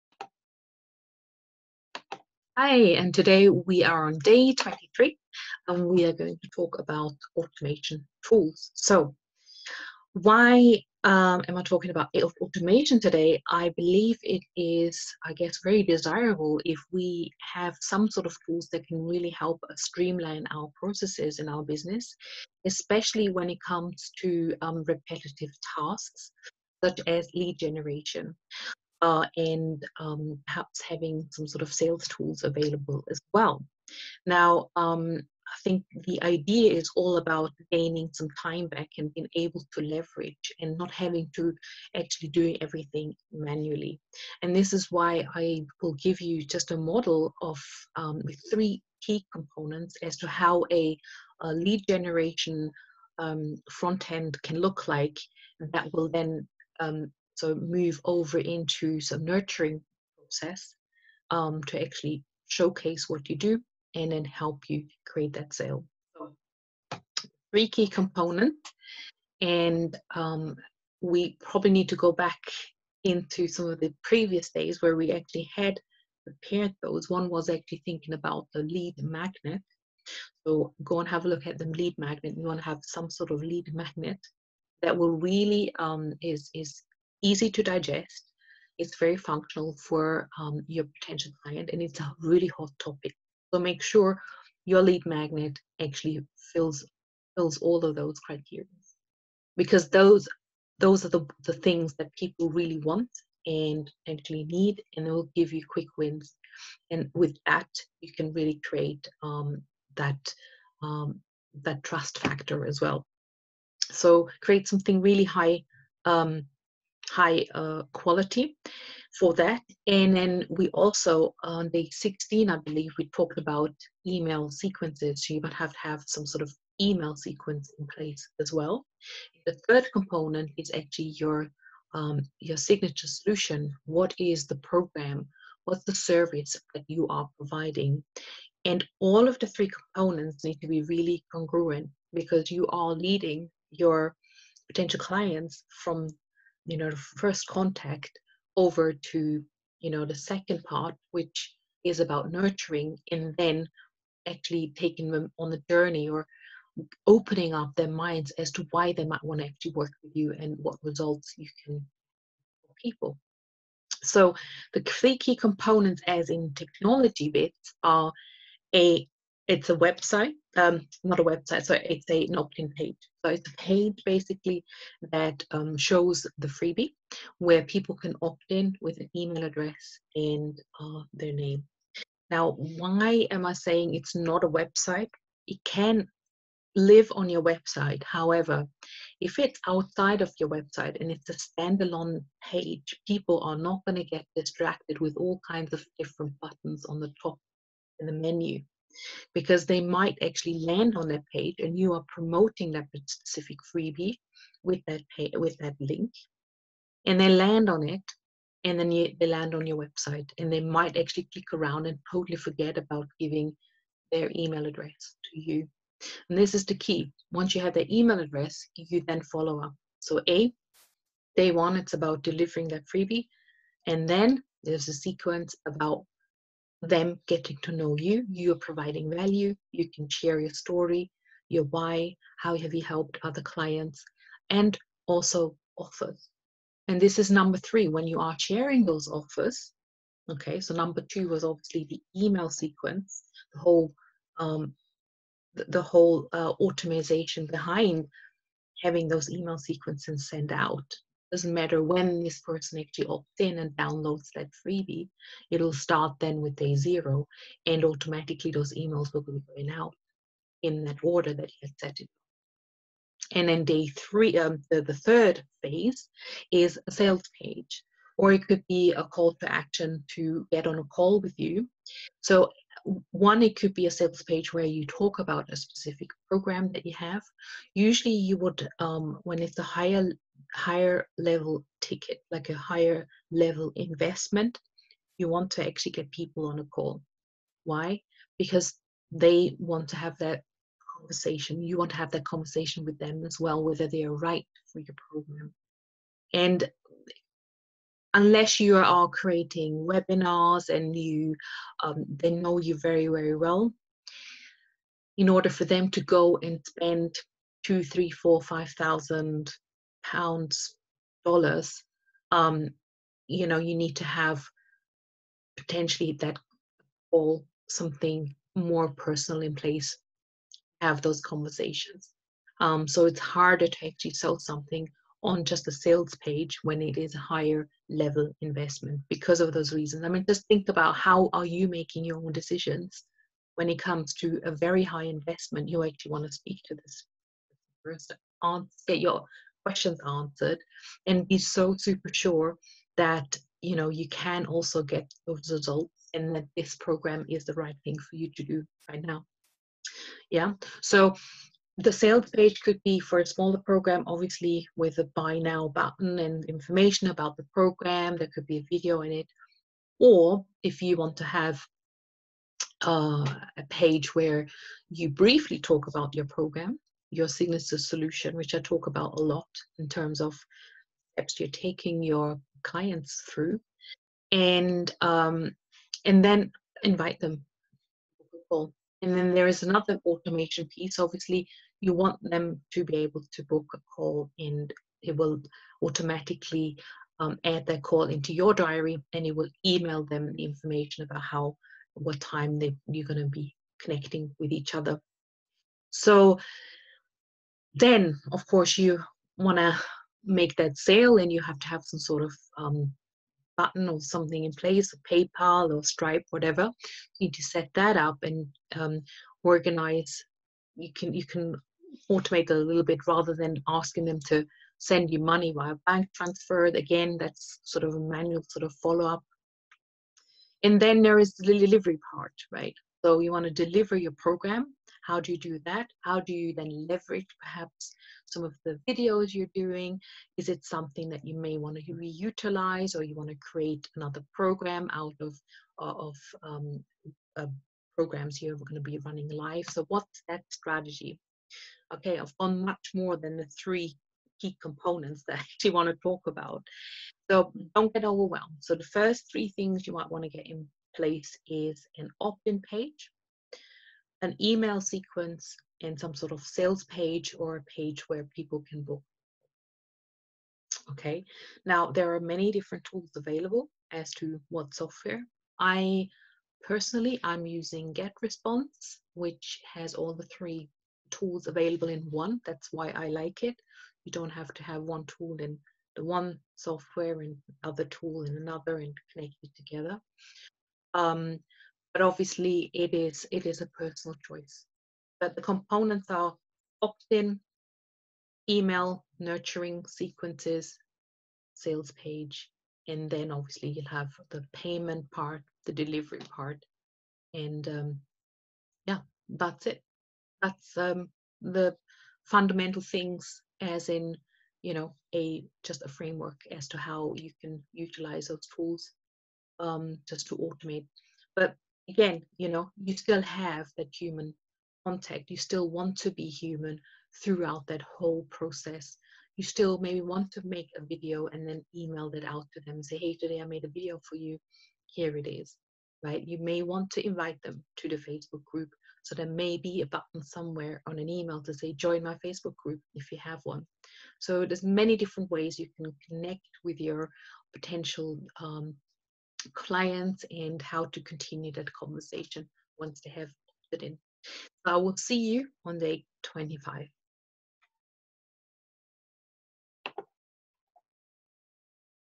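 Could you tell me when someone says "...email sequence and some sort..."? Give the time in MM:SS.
07:34.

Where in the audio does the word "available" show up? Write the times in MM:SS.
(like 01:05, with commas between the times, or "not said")
00:32, 07:43, 07:51.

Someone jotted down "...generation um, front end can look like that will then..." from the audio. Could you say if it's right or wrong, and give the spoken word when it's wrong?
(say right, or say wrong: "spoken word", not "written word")
right.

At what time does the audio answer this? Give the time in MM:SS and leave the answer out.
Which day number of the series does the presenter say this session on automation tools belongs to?
00:04.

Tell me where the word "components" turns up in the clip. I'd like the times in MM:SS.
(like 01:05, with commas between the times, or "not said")
00:49, 01:07, 02:09, 02:19, 02:45, 07:24, 08:05.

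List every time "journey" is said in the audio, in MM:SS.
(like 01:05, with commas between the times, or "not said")
02:35.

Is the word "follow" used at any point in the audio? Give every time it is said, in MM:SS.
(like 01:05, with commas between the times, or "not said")
03:39, 06:58.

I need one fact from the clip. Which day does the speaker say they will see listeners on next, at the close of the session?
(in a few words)
25.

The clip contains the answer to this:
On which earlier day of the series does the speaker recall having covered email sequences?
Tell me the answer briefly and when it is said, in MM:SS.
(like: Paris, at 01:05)
16, at 02:01.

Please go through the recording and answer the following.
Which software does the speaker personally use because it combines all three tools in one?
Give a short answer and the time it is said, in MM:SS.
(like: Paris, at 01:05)
GetResponse, at 07:47.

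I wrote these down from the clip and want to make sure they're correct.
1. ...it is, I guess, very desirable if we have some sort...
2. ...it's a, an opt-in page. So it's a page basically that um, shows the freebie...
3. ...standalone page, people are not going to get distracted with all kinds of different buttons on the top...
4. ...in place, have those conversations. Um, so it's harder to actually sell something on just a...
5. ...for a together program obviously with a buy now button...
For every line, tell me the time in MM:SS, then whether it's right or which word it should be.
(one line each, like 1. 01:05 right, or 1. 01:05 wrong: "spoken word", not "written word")
1. 00:14 right
2. 02:51 right
3. 03:11 right
4. 05:19 right
5. 05:52 wrong: "smaller", not "together".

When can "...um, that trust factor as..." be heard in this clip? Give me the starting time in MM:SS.
01:50.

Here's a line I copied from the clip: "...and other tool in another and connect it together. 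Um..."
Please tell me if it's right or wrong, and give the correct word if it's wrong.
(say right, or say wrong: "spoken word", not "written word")
right.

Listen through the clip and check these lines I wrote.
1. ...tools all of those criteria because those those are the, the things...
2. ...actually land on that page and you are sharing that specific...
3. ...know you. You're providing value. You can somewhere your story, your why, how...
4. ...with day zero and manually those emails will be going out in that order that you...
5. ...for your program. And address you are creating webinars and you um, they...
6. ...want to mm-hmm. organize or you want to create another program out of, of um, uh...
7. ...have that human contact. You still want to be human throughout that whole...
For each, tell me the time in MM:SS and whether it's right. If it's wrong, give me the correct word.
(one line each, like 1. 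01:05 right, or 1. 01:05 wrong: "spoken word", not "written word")
1. 01:37 wrong: "fills", not "tools"
2. 03:20 wrong: "promoting", not "sharing"
3. 03:47 wrong: "share", not "somewhere"
4. 04:16 wrong: "automatically", not "manually"
5. 04:54 wrong: "unless", not "address"
6. 07:11 wrong: "reutilize", not "organize"
7. 08:33 right.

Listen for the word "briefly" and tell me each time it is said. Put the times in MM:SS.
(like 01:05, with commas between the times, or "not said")
06:05.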